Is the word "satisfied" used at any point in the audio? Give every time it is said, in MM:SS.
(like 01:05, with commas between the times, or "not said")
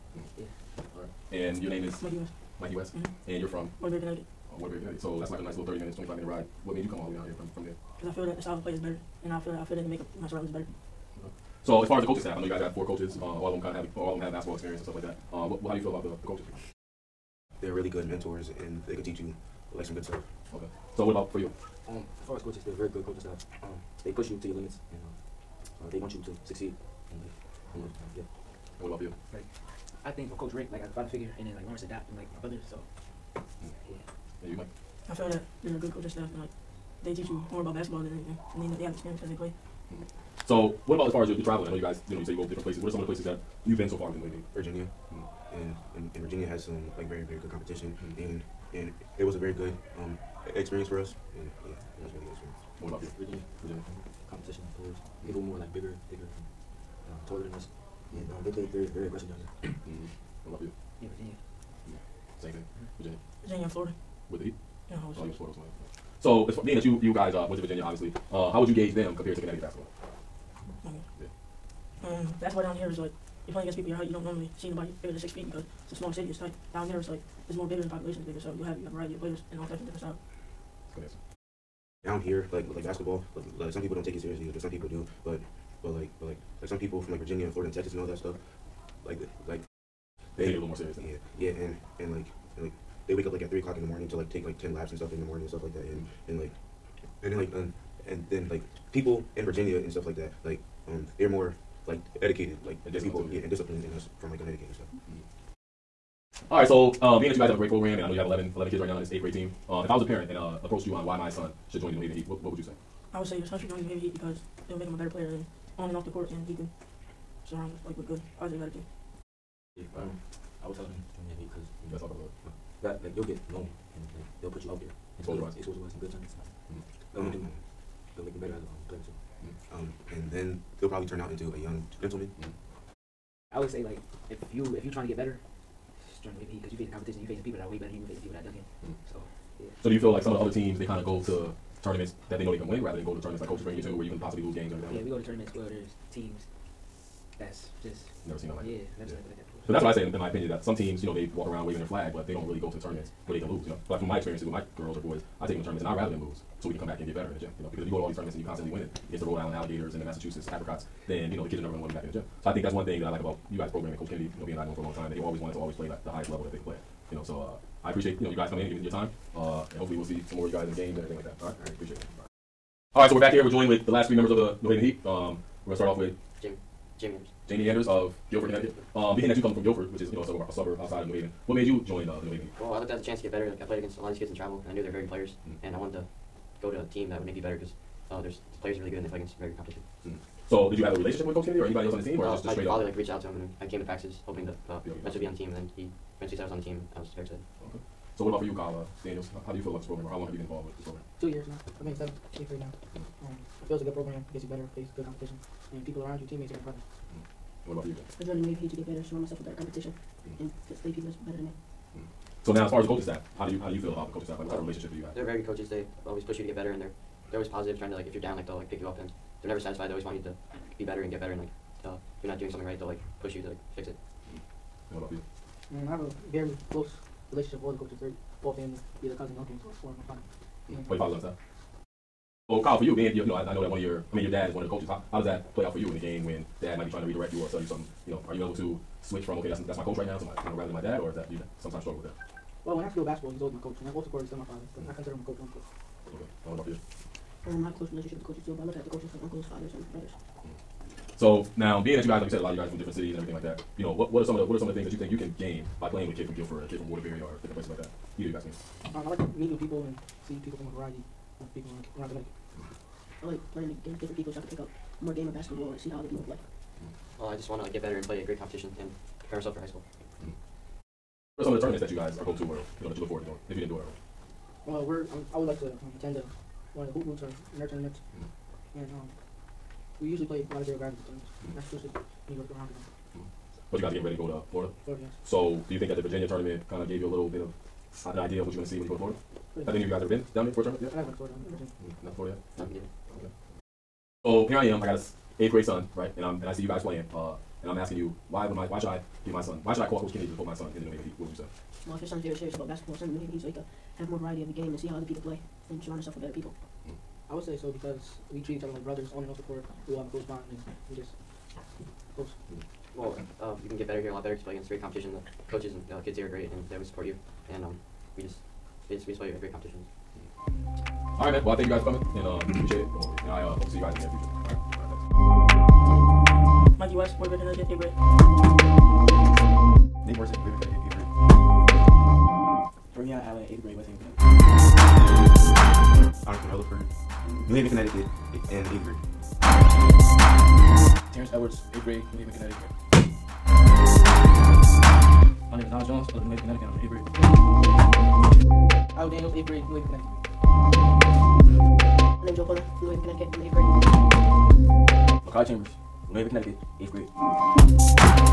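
03:39.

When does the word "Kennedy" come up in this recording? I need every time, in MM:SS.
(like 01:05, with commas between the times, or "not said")
02:44, 03:11, 05:00.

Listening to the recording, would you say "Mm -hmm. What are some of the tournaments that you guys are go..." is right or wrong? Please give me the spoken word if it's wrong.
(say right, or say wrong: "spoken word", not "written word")
right.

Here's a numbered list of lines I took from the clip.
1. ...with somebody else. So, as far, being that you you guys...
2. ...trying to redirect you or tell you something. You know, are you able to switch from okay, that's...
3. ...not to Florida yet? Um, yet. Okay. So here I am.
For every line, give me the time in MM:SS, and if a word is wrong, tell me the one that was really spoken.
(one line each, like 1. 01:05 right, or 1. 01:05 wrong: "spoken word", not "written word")
1. 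01:05 right
2. 03:56 right
3. 04:52 right.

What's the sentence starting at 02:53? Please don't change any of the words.
We're joined with the last three members of the New Haven Heat.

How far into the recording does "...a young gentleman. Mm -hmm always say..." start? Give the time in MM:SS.
02:11.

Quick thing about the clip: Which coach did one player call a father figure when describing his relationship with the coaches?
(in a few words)
Coach Rick.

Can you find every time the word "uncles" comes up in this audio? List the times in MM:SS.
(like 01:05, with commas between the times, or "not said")
03:49, 04:09.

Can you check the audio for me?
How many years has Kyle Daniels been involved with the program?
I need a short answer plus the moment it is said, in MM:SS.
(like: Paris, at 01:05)
2 years, at 03:21.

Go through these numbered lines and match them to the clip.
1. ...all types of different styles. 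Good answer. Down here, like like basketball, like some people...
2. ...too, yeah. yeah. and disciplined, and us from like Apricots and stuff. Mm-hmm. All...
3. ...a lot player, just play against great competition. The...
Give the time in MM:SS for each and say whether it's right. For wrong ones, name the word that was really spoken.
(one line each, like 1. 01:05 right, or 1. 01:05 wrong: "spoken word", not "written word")
1. 01:19 right
2. 01:43 wrong: "Connecticut", not "Apricots"
3. 05:14 wrong: "better", not "player".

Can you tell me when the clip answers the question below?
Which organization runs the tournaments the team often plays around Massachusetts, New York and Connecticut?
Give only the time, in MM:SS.
04:40.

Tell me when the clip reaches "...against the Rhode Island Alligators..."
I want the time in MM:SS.
02:39.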